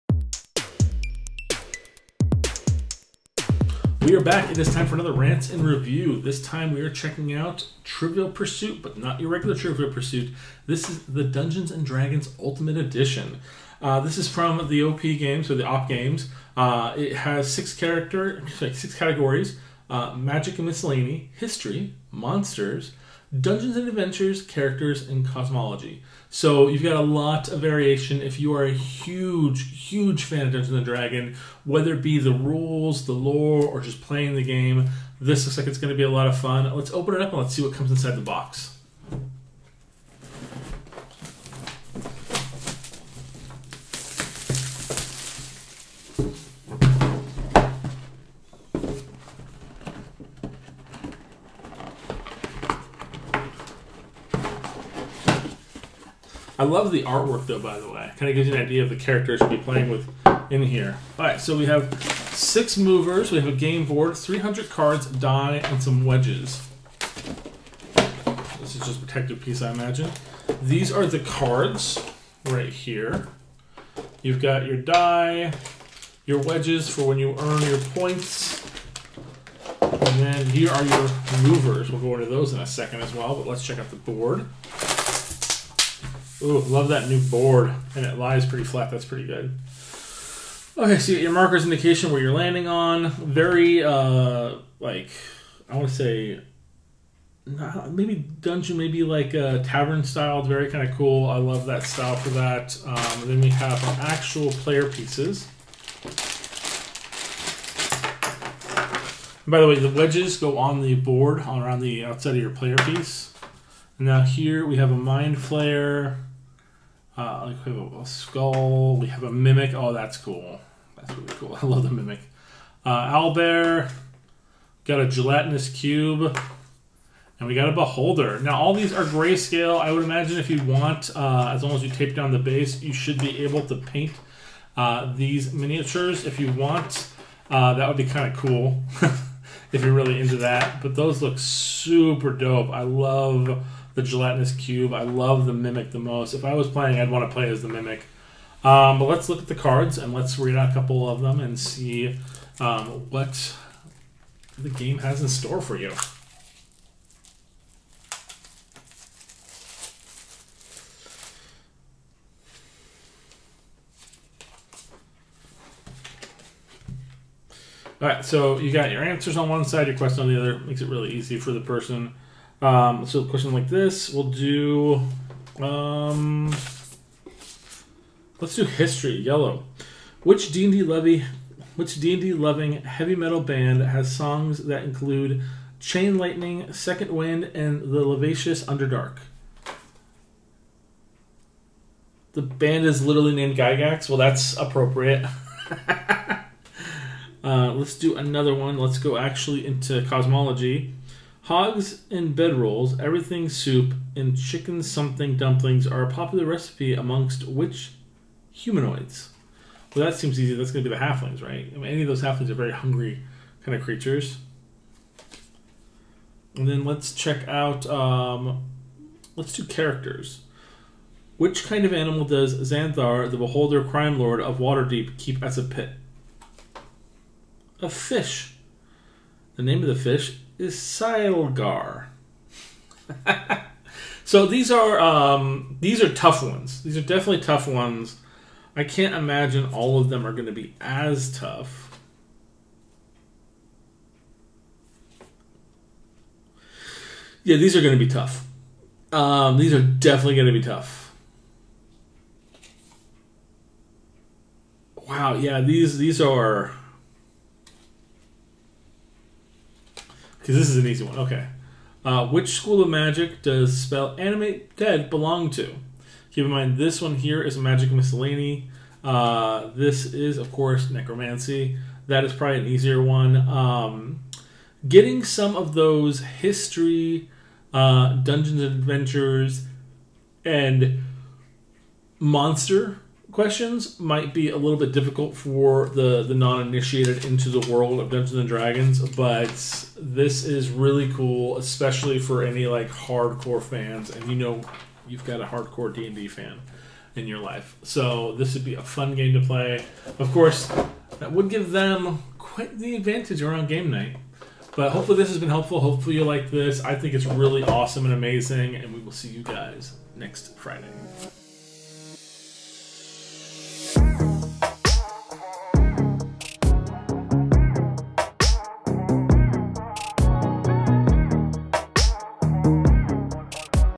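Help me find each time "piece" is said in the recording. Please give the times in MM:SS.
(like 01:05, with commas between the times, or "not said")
01:09, 01:44, 01:52.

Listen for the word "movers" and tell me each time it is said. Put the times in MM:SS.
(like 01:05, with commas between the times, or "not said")
01:02, 01:21.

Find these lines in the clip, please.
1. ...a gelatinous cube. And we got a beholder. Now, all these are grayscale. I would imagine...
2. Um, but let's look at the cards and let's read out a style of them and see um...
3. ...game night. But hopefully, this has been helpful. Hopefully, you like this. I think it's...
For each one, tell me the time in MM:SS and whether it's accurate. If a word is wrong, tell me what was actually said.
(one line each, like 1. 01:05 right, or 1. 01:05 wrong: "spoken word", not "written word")
1. 02:05 right
2. 02:28 wrong: "couple", not "style"
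3. 05:03 right.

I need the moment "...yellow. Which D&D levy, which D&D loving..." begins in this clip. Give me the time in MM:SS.
02:59.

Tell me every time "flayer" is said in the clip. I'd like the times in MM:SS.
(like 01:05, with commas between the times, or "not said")
01:55.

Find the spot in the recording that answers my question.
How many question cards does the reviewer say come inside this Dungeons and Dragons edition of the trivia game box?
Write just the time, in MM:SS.
01:04.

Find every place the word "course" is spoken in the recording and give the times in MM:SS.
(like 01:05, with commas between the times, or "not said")
04:30, 05:00.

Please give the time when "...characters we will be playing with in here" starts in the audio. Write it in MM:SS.
00:58.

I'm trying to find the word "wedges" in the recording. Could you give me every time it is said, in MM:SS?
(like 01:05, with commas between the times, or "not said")
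01:06, 01:16, 01:49.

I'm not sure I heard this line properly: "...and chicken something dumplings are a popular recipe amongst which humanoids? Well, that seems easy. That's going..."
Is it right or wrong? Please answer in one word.
right.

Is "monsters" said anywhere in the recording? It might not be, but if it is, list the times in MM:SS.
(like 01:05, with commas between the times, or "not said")
00:22, 04:42.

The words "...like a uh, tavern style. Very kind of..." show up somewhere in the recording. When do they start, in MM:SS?
01:39.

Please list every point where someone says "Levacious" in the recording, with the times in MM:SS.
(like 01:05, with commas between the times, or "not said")
03:08.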